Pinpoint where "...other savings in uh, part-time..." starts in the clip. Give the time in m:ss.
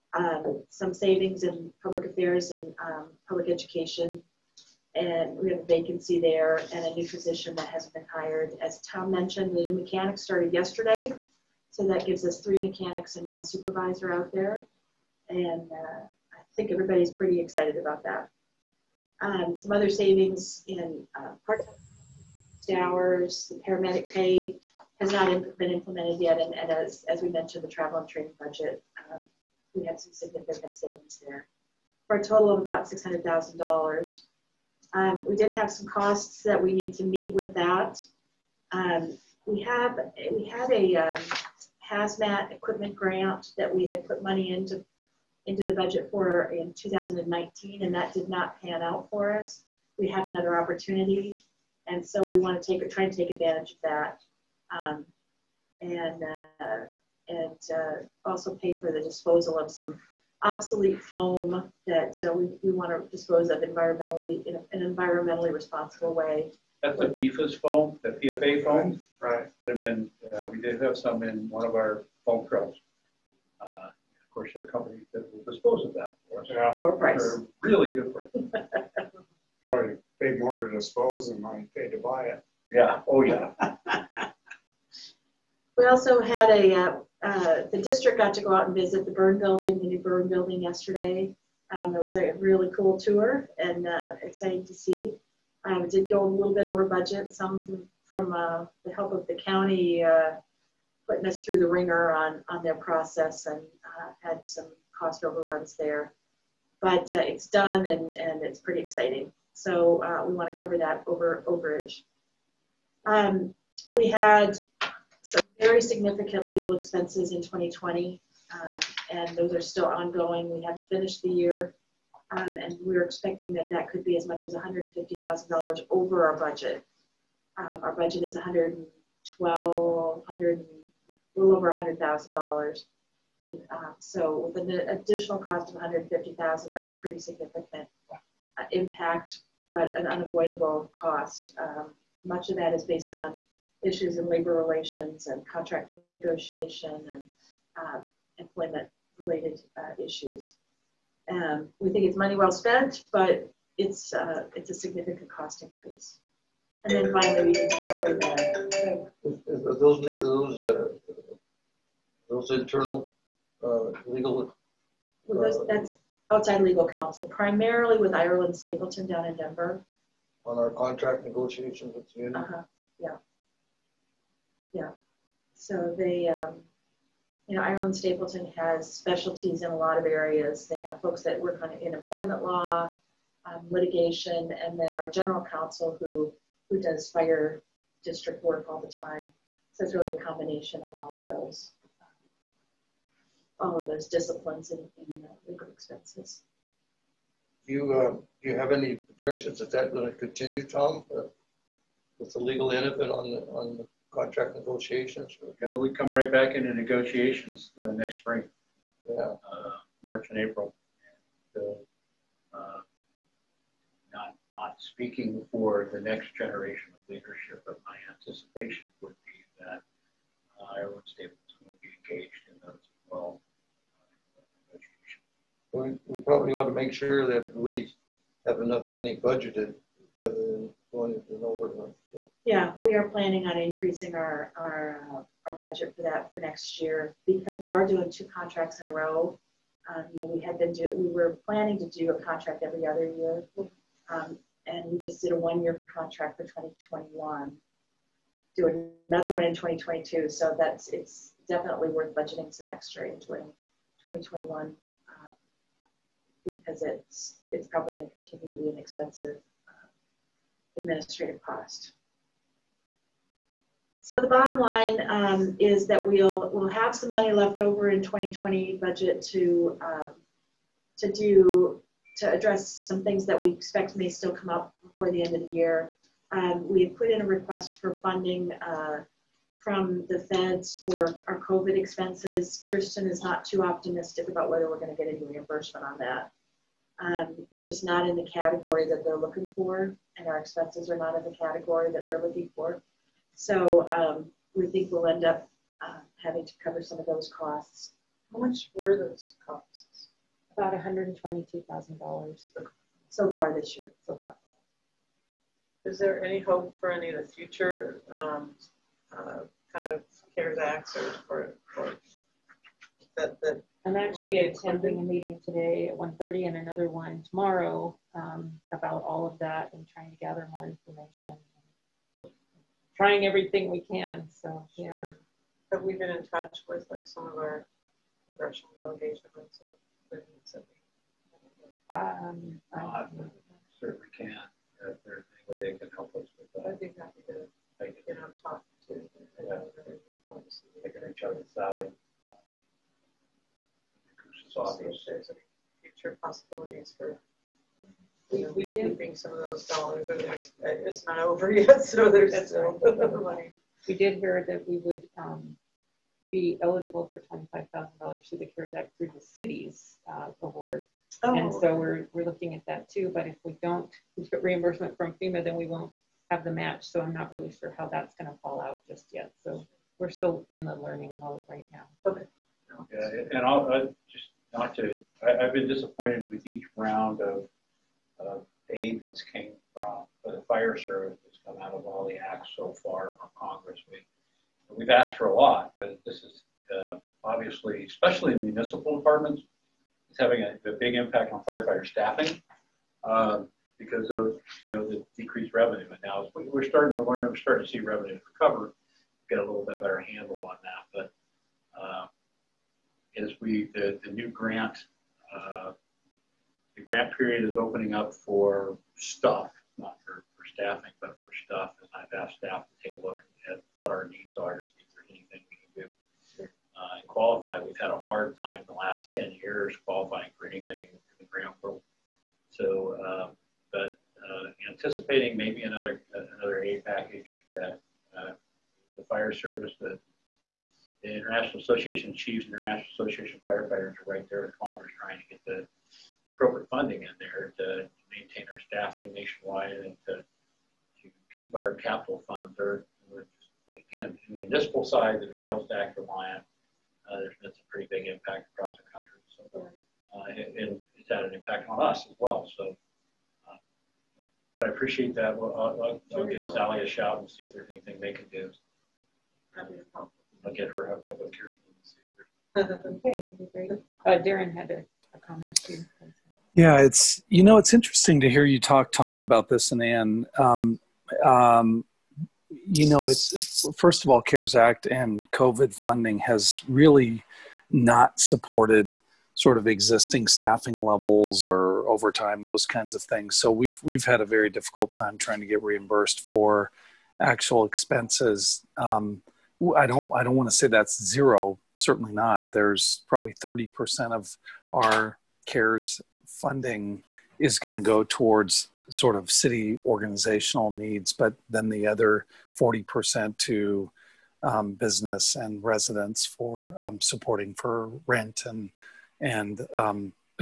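0:19.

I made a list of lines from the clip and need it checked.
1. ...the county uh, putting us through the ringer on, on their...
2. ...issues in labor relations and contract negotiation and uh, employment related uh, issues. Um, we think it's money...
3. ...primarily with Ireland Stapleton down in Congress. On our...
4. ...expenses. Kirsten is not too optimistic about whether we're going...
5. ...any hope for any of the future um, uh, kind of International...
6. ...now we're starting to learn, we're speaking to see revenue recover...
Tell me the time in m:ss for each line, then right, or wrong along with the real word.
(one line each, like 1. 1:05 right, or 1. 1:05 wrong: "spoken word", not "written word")
1. 1:39 right
2. 2:23 right
3. 2:47 wrong: "Denver", not "Congress"
4. 4:41 right
5. 5:06 wrong: "CARES", not "International"
6. 6:36 wrong: "starting", not "speaking".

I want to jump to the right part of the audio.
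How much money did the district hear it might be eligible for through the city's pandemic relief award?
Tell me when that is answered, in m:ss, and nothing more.
5:57.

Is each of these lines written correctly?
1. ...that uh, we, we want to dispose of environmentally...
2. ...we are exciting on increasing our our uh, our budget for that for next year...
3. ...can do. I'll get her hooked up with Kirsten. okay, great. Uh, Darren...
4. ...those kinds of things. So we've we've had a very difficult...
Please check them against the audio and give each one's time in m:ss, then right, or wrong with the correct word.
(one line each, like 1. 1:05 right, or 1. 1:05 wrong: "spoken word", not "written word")
1. 1:01 right
2. 3:52 wrong: "planning", not "exciting"
3. 7:38 right
4. 8:02 right.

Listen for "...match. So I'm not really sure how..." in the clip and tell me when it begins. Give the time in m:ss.
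6:06.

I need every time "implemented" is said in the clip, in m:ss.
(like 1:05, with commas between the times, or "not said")
0:25.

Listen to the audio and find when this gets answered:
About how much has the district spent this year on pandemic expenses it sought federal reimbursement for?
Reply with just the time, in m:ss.
5:00.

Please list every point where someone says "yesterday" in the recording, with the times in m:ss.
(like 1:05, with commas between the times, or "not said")
0:10, 1:30.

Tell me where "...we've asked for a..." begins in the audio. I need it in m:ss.
6:24.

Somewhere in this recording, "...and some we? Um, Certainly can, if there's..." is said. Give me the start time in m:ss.
5:29.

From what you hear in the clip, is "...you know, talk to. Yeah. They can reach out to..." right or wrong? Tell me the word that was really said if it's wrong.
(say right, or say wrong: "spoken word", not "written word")
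right.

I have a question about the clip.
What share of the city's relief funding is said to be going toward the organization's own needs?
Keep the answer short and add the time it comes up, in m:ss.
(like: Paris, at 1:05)
30%, at 8:13.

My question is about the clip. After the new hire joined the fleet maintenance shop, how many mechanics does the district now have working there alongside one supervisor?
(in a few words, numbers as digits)
3.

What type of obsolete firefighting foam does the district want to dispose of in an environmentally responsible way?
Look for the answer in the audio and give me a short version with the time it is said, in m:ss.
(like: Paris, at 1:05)
PFAS foam, at 1:07.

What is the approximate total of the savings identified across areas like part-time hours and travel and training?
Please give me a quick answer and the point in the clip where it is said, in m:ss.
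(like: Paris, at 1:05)
$600,000, at 0:32.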